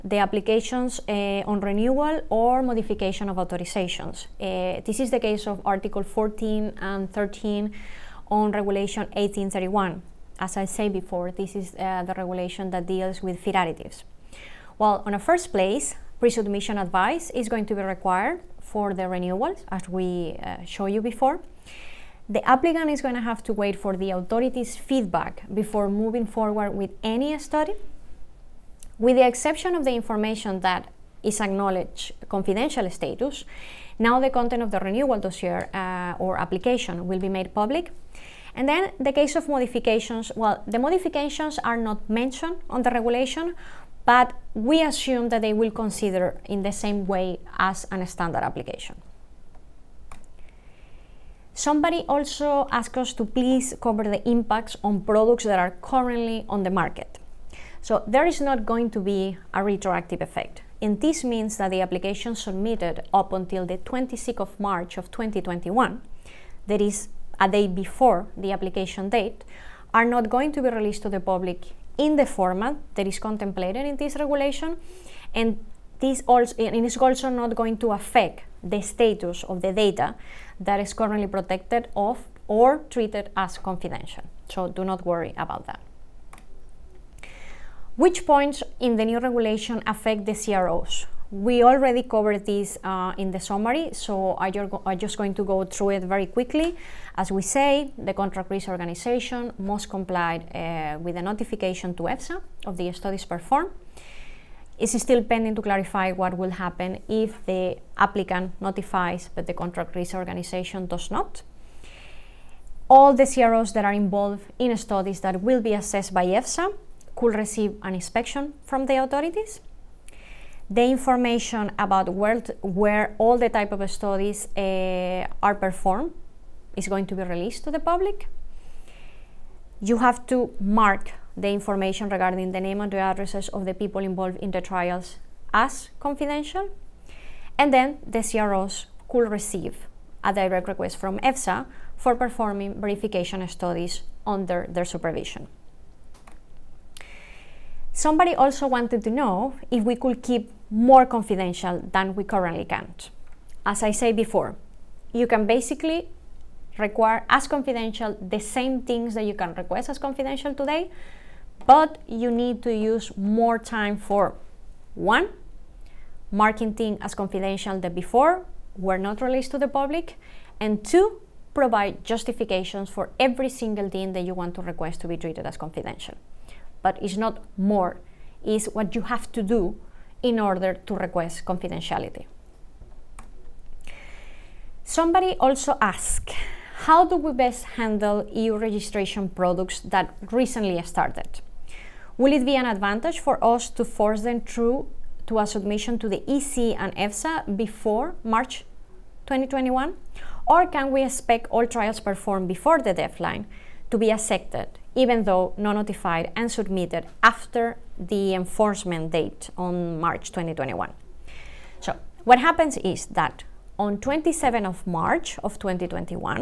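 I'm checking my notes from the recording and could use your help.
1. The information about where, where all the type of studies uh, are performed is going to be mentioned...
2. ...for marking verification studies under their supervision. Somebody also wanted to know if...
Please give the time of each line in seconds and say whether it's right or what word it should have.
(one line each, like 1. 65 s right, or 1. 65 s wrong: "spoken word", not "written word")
1. 120 s wrong: "released", not "mentioned"
2. 141 s wrong: "performing", not "marking".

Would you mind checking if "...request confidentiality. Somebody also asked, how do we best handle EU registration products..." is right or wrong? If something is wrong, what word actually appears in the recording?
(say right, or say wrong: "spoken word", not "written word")
right.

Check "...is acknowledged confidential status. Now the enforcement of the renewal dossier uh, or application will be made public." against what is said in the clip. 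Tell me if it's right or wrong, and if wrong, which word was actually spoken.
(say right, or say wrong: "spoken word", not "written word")
wrong: "content", not "enforcement".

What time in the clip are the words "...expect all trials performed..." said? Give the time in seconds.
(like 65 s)
201 s.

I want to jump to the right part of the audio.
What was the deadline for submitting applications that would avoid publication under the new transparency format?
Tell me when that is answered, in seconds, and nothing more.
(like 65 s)
63 s.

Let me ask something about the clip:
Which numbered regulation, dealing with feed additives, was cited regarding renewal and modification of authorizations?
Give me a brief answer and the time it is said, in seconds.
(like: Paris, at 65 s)
Regulation 1831, at 8 s.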